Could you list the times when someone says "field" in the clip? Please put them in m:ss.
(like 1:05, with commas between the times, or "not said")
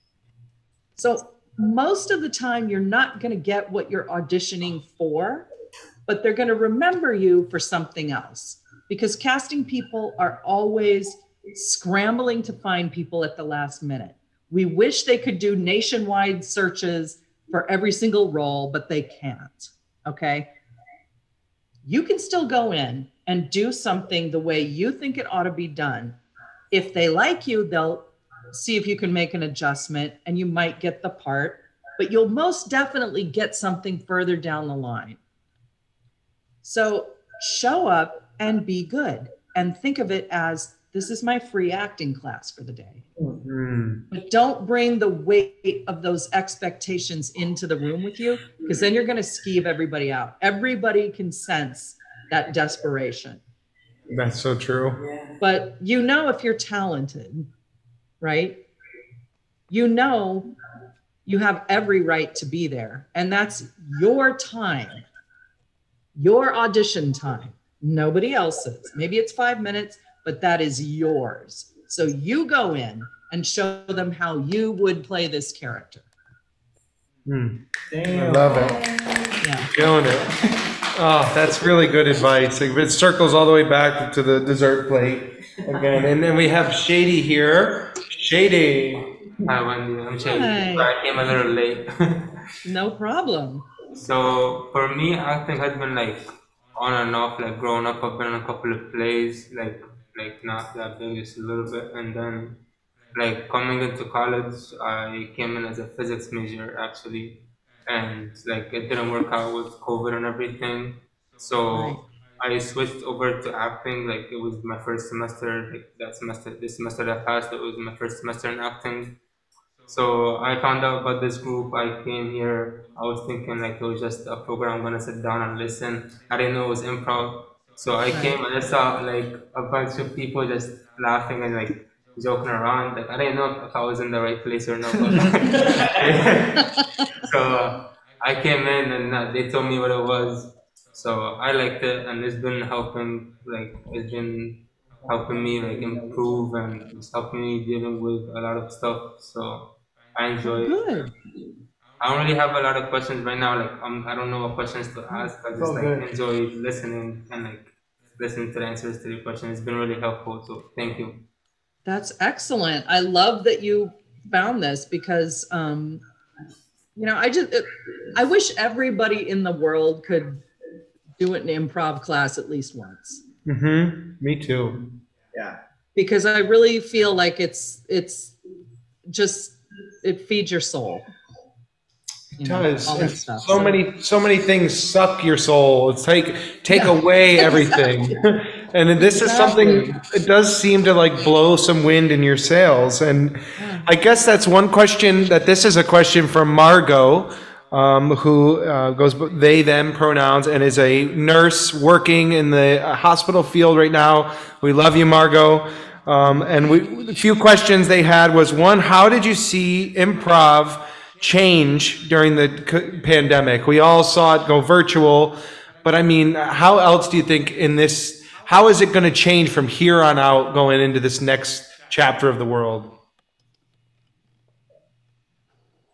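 3:23.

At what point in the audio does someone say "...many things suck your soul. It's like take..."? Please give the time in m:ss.
3:04.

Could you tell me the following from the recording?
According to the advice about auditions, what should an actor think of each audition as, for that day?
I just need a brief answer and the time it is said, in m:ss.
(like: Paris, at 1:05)
free acting class, at 0:41.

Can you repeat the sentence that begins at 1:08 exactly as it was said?
Maybe it's five minutes, but that is yours.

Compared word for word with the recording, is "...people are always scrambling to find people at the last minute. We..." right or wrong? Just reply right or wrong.
right.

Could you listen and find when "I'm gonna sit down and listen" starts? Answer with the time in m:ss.
2:04.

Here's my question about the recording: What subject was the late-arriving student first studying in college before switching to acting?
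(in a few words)
physics.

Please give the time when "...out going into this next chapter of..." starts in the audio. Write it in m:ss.
3:40.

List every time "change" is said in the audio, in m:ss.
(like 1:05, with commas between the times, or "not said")
3:31, 3:39.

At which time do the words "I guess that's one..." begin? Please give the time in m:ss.
3:13.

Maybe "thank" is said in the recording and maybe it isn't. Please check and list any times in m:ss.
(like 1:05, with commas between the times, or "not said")
2:40.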